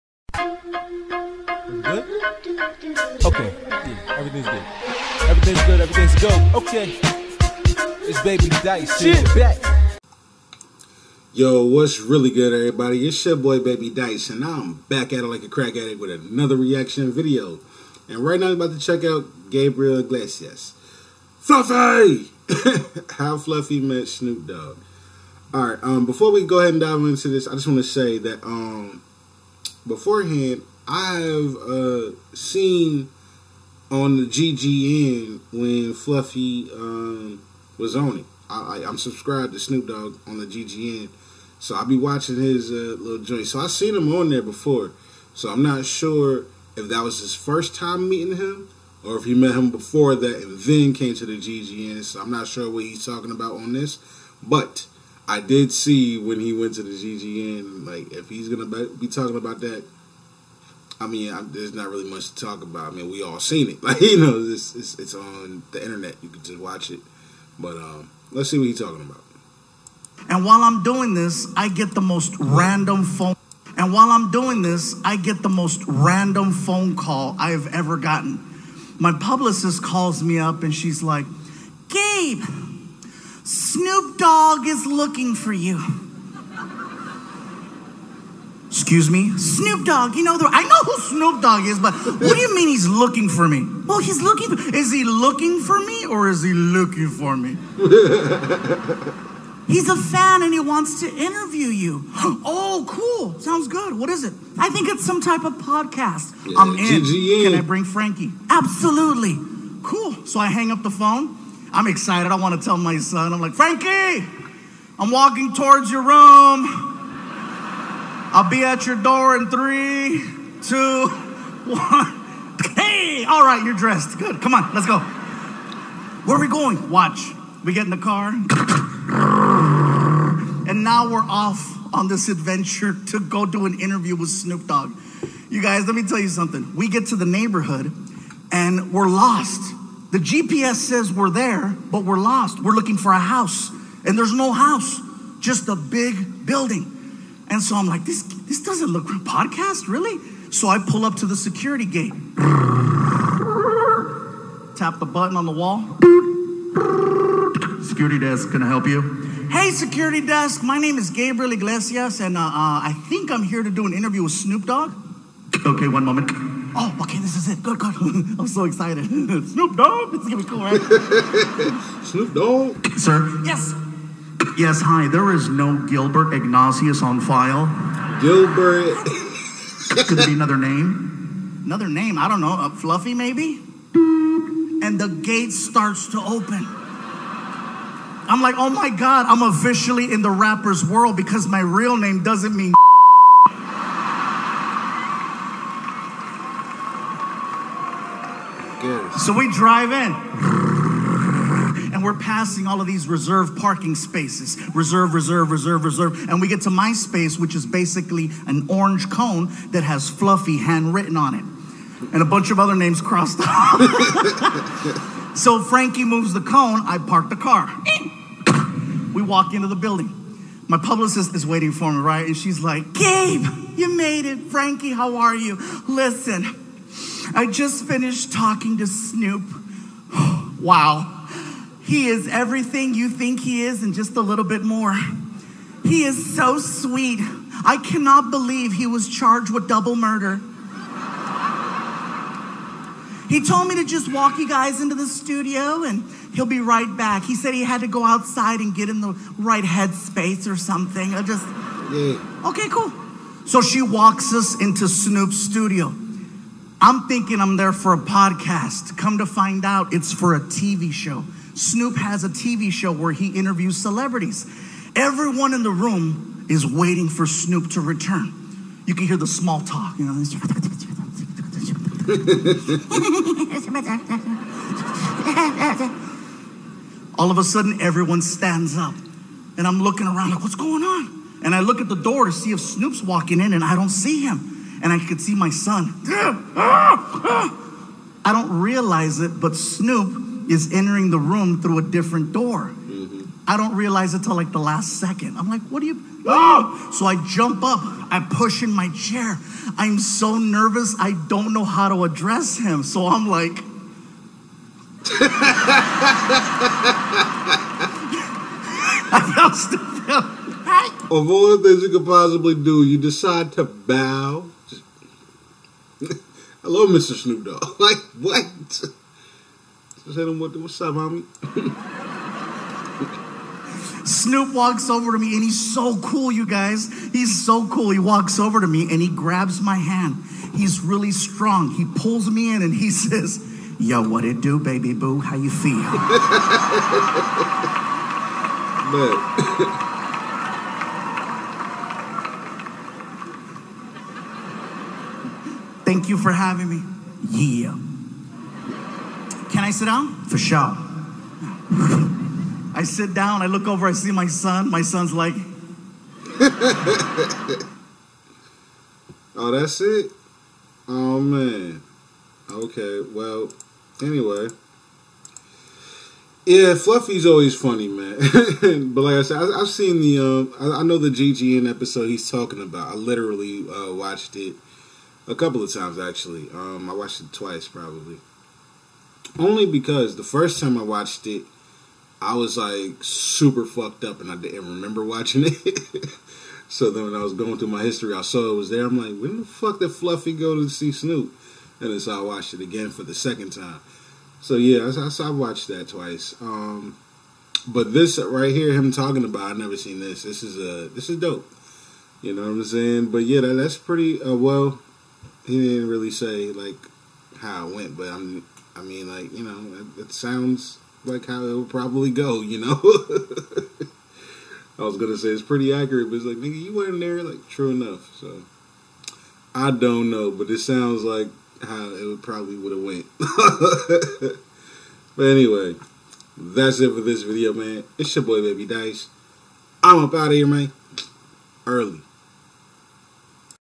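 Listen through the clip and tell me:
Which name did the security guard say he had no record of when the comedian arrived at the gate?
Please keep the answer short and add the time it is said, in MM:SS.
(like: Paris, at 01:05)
Gilbert Ignatius, at 02:55.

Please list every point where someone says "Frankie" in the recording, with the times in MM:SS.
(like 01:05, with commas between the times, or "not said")
01:47, 01:53, 03:35, 03:44.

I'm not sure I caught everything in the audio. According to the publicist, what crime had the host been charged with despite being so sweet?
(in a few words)
double murder.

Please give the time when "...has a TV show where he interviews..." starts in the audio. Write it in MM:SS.
04:21.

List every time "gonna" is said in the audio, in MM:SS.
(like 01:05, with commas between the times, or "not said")
00:58, 02:50, 06:54.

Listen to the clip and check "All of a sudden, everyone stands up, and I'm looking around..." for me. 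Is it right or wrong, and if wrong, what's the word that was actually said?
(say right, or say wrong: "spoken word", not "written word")
right.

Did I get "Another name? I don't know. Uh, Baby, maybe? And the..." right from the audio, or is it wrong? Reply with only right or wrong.
wrong.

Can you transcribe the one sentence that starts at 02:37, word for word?
Security desk, can I help you?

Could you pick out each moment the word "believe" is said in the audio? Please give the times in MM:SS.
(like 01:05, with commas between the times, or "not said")
03:58.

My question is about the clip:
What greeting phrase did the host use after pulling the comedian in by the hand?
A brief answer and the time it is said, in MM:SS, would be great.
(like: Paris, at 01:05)
What it do, baby boo, at 05:34.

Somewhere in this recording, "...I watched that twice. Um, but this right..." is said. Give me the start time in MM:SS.
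06:35.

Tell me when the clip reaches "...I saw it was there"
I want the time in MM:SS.
06:28.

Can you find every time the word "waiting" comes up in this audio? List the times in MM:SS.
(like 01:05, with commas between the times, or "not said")
03:41, 04:26.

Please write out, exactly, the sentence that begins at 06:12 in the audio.
I literally uh, watched it a couple of times actually.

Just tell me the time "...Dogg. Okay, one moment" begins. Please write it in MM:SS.
02:44.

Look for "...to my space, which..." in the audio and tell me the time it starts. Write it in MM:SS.
03:26.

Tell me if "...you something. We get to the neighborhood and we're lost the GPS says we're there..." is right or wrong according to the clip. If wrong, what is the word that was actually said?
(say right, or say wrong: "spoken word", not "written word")
right.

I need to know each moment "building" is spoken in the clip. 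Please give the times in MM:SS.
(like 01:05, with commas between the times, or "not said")
02:26, 03:39.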